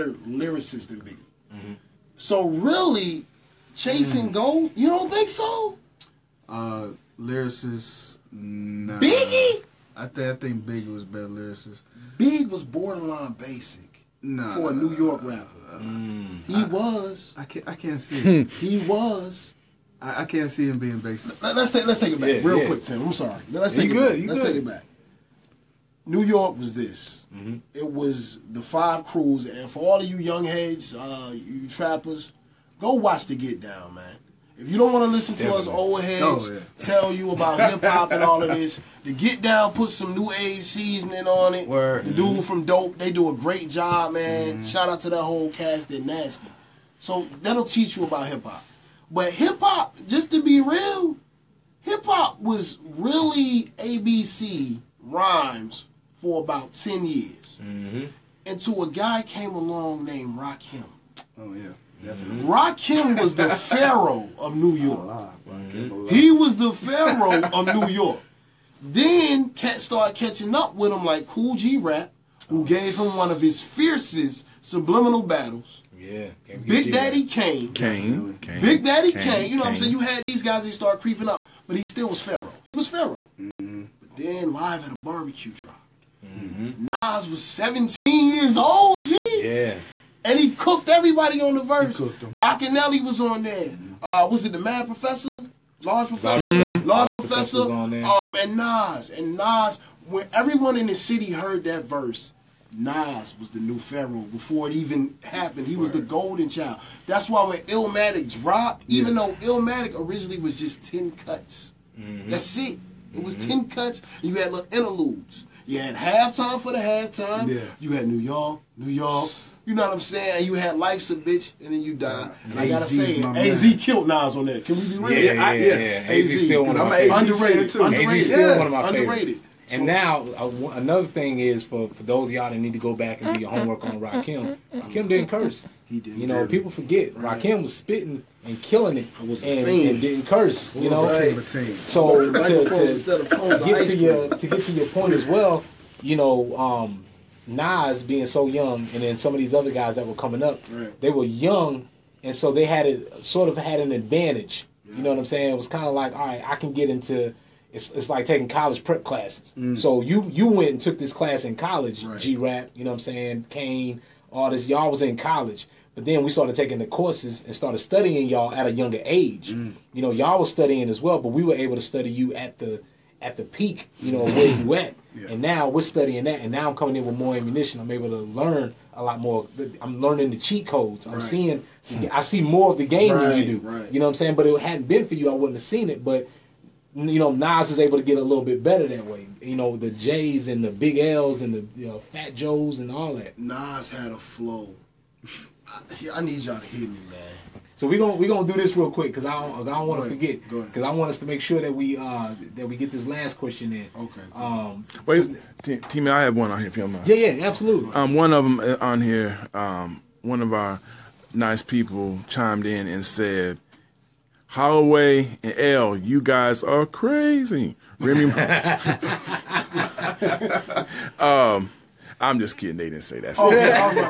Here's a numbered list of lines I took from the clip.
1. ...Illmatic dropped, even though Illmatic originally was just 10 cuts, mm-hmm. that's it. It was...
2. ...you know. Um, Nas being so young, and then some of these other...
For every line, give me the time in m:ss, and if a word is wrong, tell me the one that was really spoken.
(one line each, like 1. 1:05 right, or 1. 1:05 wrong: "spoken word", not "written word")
1. 1:47 right
2. 2:26 right.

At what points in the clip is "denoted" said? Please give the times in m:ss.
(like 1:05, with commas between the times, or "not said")
not said.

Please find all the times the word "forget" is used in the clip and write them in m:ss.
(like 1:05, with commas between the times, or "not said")
2:16, 3:20.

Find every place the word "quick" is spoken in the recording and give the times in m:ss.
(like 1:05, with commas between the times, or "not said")
0:22, 3:18.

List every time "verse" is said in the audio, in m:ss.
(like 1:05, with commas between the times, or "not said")
1:31, 1:41.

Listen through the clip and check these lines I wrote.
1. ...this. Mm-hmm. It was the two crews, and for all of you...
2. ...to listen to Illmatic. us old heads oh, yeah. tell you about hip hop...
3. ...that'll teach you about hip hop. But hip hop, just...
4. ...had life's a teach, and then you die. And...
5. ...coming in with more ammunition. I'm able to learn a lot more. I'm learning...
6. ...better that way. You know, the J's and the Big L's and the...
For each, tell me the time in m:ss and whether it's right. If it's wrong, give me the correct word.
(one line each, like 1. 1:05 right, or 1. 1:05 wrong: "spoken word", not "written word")
1. 0:26 wrong: "five", not "two"
2. 0:35 wrong: "Definitely", not "Illmatic"
3. 0:47 right
4. 2:00 wrong: "bitch", not "teach"
5. 2:56 right
6. 3:08 right.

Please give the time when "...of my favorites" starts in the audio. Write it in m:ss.
2:06.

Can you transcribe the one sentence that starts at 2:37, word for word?
It's, it's like taking college prep classes.